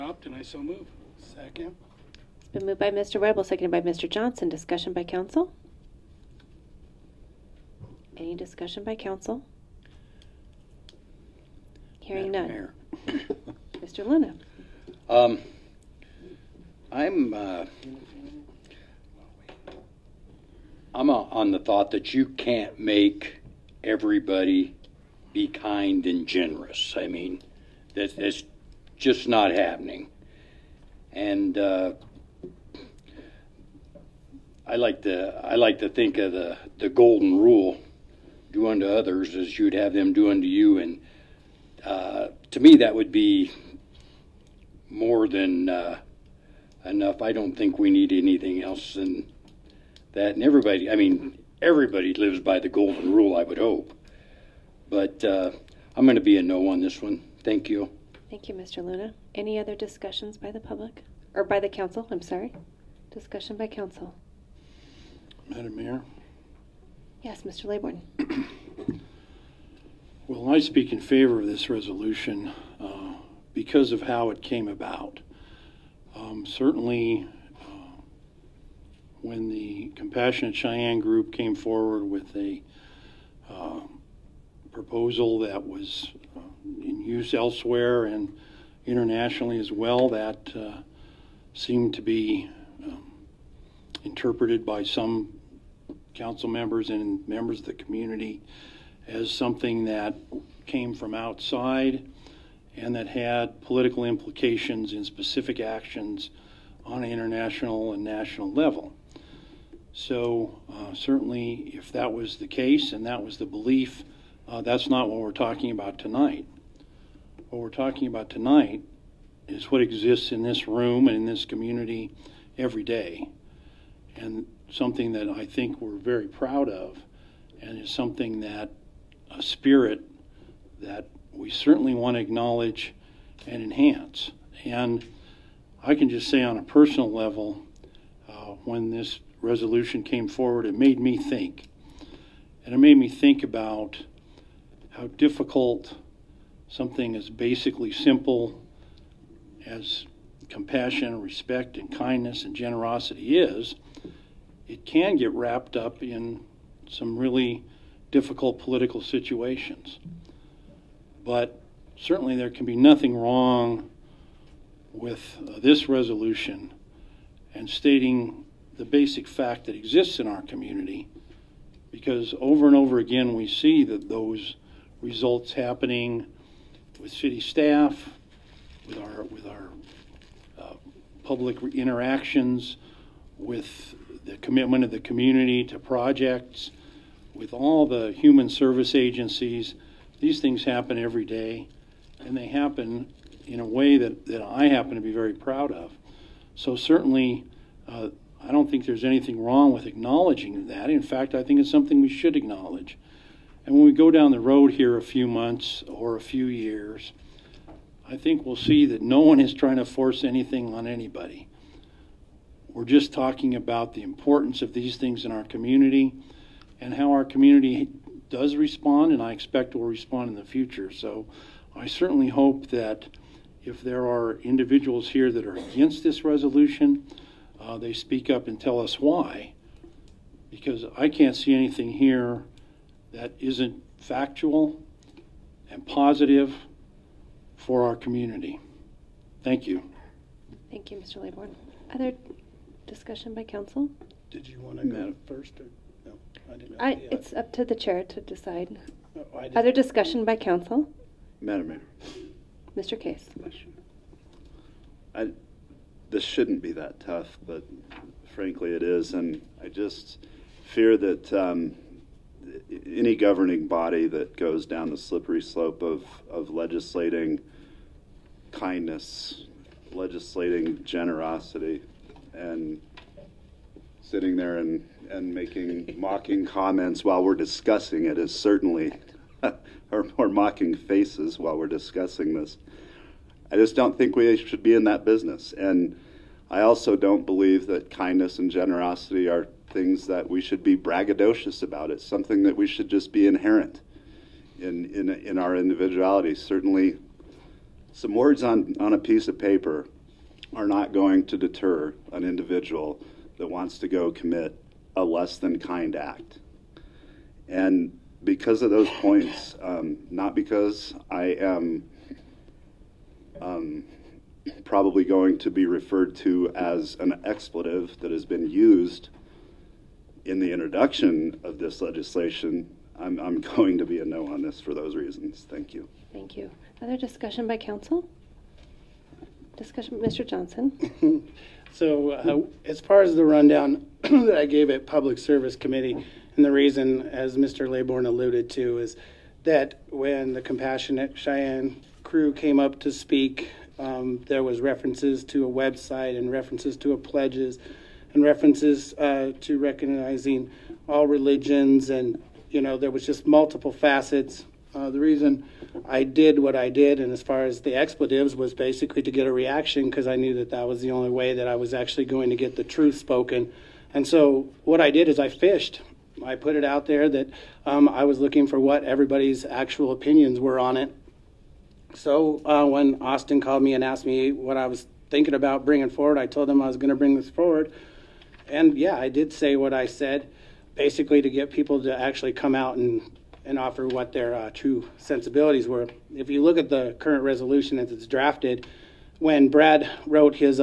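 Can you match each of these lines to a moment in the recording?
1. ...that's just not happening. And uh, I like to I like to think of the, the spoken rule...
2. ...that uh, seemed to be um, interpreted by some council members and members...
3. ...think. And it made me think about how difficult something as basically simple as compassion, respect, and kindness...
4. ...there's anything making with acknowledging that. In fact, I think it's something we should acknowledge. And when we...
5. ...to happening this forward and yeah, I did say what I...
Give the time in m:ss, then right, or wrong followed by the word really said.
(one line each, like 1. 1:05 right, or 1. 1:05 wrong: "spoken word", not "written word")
1. 0:28 wrong: "golden", not "spoken"
2. 1:30 right
3. 2:21 right
4. 3:18 wrong: "wrong", not "making"
5. 6:16 wrong: "bring", not "happening".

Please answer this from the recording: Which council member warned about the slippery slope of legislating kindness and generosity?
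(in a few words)
Mr. Case.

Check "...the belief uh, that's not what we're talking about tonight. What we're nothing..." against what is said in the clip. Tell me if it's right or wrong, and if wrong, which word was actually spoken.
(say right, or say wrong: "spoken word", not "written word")
wrong: "talking", not "nothing".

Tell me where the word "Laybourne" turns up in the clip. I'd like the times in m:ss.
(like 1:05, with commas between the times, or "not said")
1:07, 4:01, 5:37.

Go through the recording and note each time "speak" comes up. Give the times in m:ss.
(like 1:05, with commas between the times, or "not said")
1:10, 3:47, 5:42.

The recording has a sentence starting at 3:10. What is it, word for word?
These things happen every day, and they happen in a way that, that I happen to be very proud of.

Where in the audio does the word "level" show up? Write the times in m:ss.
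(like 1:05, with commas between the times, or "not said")
1:48, 2:17.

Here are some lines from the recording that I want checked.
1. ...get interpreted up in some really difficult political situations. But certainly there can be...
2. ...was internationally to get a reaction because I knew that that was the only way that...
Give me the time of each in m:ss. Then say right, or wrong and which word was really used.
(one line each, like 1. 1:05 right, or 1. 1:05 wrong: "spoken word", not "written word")
1. 2:35 wrong: "wrapped", not "interpreted"
2. 5:58 wrong: "basically", not "internationally".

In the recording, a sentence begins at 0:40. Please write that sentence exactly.
And uh, to me, that would be more than uh, enough.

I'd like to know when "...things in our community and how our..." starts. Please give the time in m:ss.
3:34.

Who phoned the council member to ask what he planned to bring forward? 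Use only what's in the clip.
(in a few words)
Austin.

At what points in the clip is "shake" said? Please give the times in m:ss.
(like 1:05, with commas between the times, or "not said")
not said.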